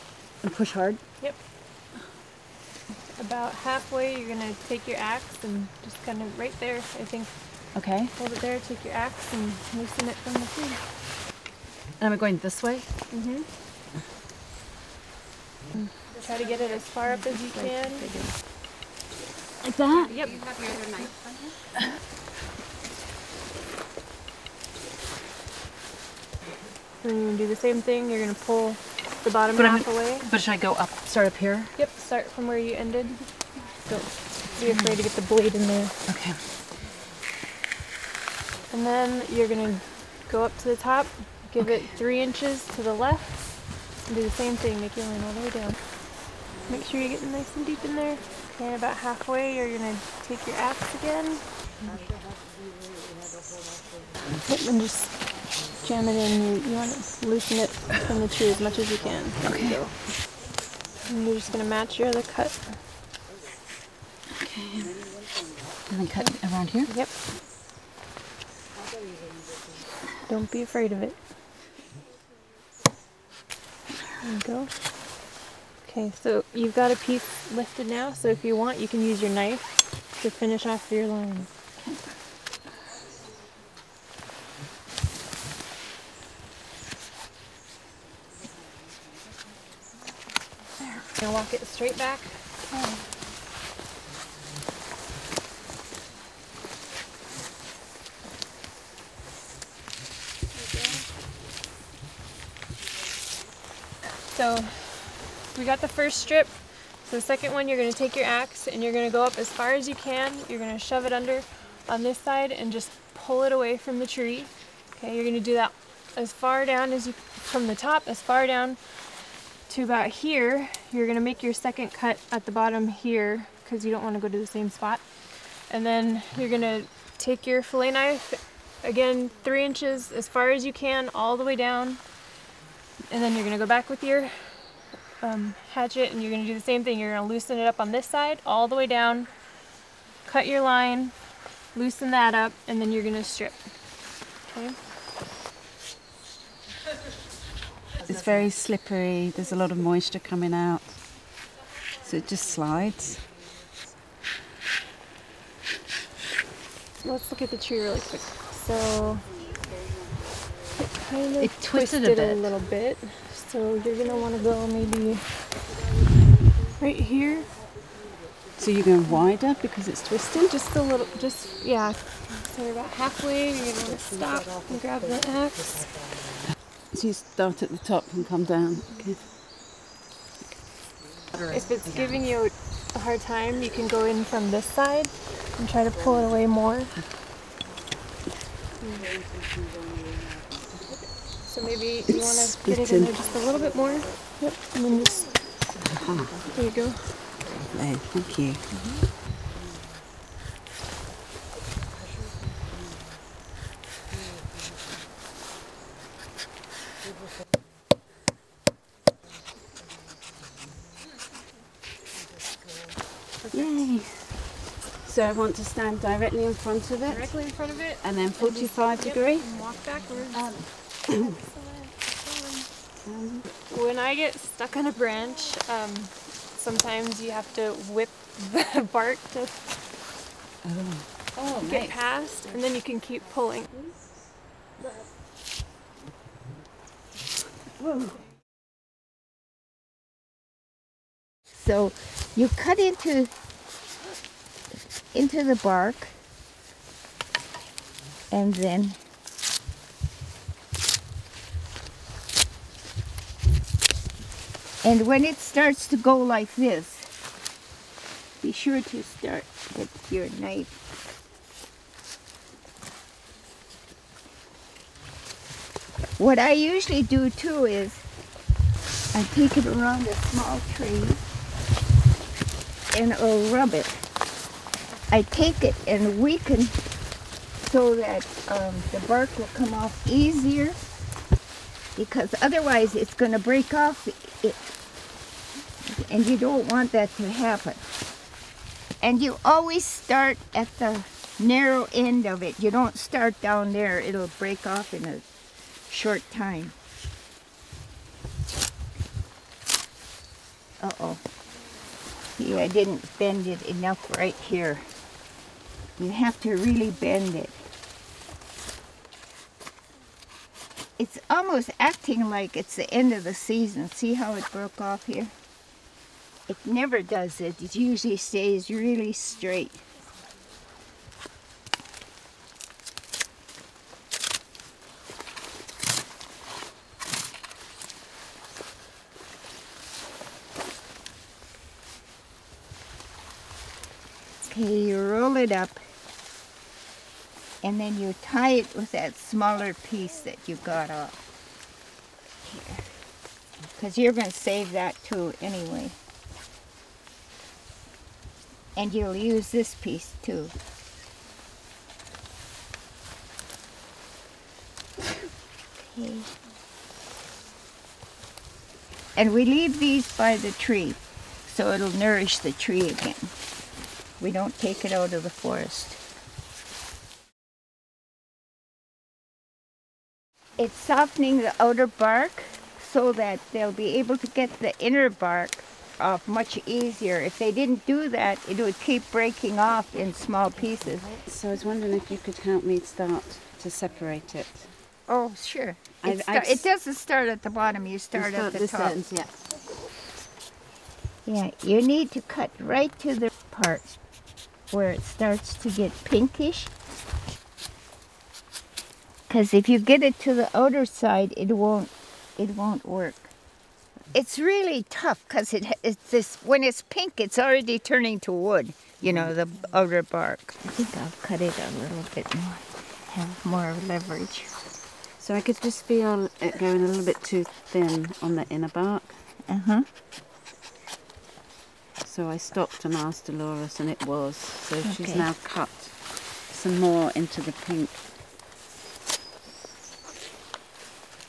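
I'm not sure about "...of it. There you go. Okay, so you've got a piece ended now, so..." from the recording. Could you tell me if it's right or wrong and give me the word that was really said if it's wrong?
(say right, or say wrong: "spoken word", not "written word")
wrong: "lifted", not "ended".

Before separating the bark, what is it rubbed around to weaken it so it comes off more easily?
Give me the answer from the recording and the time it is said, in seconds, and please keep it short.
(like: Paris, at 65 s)
A small tree, at 270 s.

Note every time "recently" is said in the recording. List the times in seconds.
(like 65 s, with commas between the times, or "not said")
not said.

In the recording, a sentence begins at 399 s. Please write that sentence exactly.
Because if you get it to the outer side, it won't, it won't work.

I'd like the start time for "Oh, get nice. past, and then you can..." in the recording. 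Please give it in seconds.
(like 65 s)
231 s.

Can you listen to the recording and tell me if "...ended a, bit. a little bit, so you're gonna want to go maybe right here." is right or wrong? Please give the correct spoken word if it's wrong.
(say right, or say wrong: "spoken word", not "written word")
wrong: "twisted", not "ended".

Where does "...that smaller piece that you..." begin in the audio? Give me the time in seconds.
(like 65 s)
338 s.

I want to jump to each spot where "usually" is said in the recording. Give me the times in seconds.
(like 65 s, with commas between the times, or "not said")
266 s, 317 s.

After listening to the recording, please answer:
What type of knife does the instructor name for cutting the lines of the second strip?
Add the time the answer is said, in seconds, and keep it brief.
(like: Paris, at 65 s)
Fillet knife, at 127 s.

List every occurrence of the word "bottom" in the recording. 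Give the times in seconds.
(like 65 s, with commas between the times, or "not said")
29 s, 122 s, 387 s.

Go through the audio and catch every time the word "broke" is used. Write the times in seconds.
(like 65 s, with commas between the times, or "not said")
314 s.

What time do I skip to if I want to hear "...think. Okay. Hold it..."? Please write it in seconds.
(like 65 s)
7 s.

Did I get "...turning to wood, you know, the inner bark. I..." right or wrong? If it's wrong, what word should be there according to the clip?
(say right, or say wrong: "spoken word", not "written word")
wrong: "outer", not "inner".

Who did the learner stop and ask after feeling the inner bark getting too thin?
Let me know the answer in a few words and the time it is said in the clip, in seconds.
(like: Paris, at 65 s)
Delores, at 423 s.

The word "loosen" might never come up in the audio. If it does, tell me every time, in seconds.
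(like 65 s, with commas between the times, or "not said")
9 s, 57 s, 137 s, 141 s.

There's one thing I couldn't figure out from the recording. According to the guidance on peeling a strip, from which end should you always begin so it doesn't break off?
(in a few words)
The narrow end.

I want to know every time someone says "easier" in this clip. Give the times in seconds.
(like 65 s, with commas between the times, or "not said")
280 s, 376 s.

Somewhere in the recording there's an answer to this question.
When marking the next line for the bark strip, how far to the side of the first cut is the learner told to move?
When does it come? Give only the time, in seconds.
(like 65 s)
41 s.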